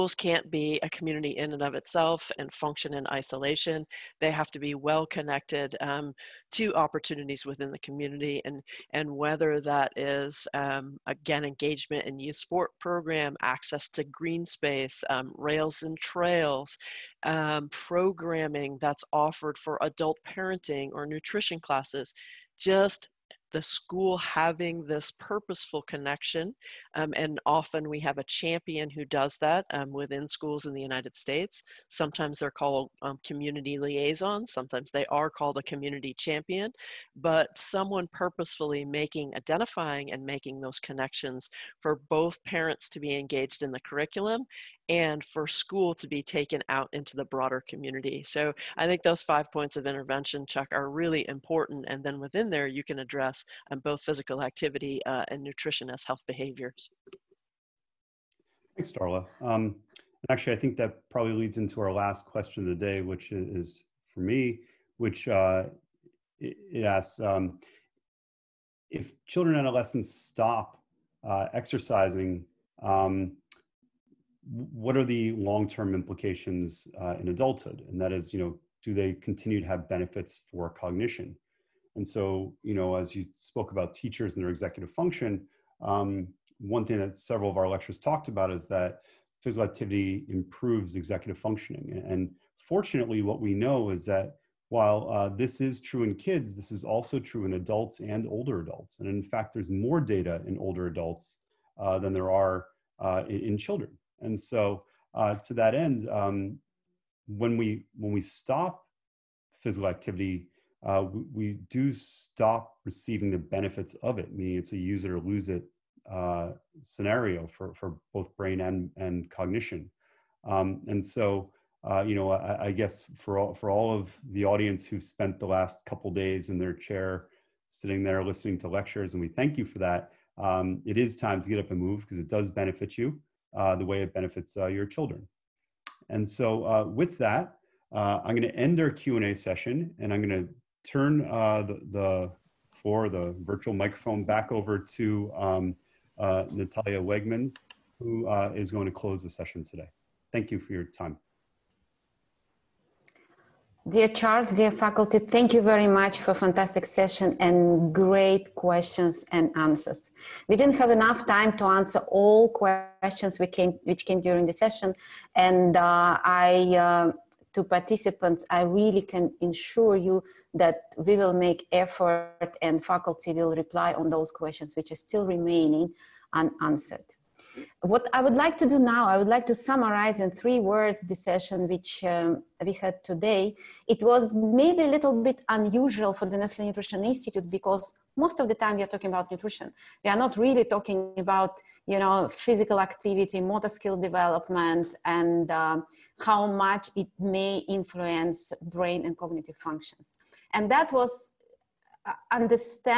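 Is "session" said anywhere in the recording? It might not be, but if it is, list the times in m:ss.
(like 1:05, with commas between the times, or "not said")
2:19, 2:29, 2:36, 2:44, 3:01.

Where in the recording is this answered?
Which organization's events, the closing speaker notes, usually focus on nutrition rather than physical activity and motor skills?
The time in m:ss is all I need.
3:06.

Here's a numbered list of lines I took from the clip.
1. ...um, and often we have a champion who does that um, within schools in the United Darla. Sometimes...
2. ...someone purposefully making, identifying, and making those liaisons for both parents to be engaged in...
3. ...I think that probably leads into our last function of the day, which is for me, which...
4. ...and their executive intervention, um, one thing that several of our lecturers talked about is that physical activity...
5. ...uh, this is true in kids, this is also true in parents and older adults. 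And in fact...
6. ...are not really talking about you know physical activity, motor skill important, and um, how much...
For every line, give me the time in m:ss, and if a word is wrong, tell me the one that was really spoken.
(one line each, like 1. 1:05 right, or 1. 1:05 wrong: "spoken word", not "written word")
1. 0:26 wrong: "States", not "Darla"
2. 0:37 wrong: "connections", not "liaisons"
3. 1:00 wrong: "question", not "function"
4. 1:24 wrong: "function", not "intervention"
5. 1:35 wrong: "adults", not "parents"
6. 3:10 wrong: "development", not "important".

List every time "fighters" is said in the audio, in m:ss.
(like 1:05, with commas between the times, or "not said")
not said.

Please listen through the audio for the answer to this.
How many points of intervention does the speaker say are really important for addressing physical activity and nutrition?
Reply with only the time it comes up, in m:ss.
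0:49.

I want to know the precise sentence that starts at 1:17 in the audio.
And that is, you know, do they continue to have benefits for cognition?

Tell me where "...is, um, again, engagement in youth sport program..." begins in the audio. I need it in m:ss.
0:09.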